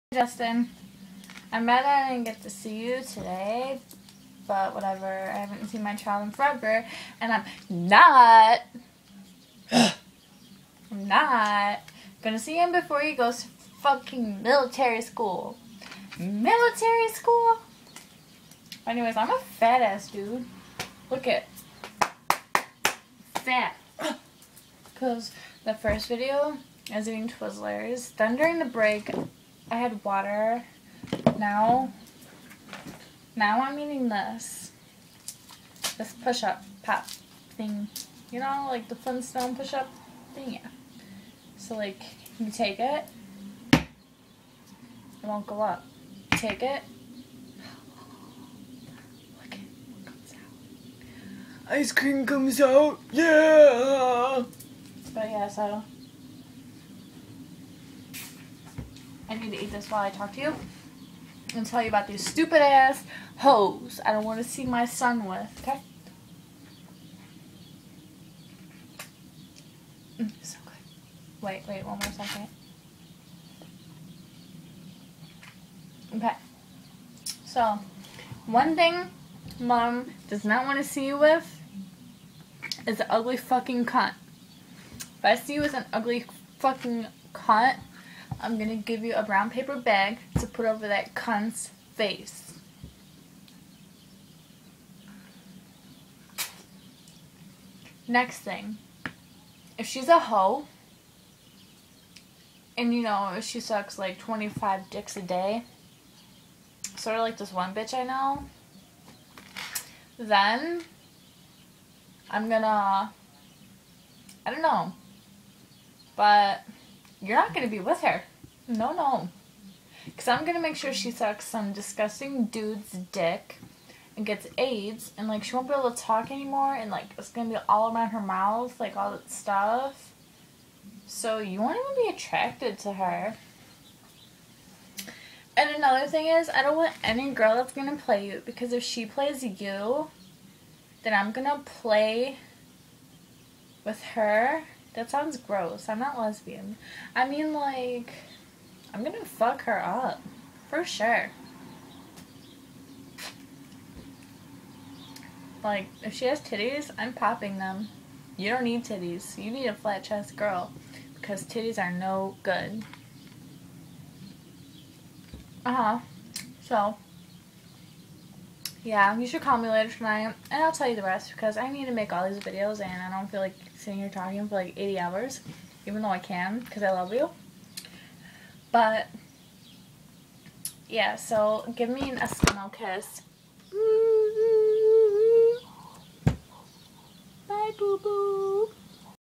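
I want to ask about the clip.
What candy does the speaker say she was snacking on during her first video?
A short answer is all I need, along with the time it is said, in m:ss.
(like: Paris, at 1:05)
Twizzlers, at 0:27.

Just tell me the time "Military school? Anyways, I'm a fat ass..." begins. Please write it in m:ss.
0:16.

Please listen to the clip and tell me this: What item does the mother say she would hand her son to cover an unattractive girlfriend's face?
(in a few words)
brown paper bag.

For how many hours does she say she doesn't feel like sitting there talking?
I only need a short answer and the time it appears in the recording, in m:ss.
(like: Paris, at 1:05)
80, at 2:54.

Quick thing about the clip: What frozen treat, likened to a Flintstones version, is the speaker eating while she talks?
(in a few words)
push-up pop.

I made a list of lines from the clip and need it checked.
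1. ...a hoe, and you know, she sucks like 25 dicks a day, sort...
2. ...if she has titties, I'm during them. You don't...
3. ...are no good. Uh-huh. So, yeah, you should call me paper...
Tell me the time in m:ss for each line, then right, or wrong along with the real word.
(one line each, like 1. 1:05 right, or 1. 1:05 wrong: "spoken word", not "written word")
1. 1:40 right
2. 2:36 wrong: "popping", not "during"
3. 2:41 wrong: "later", not "paper".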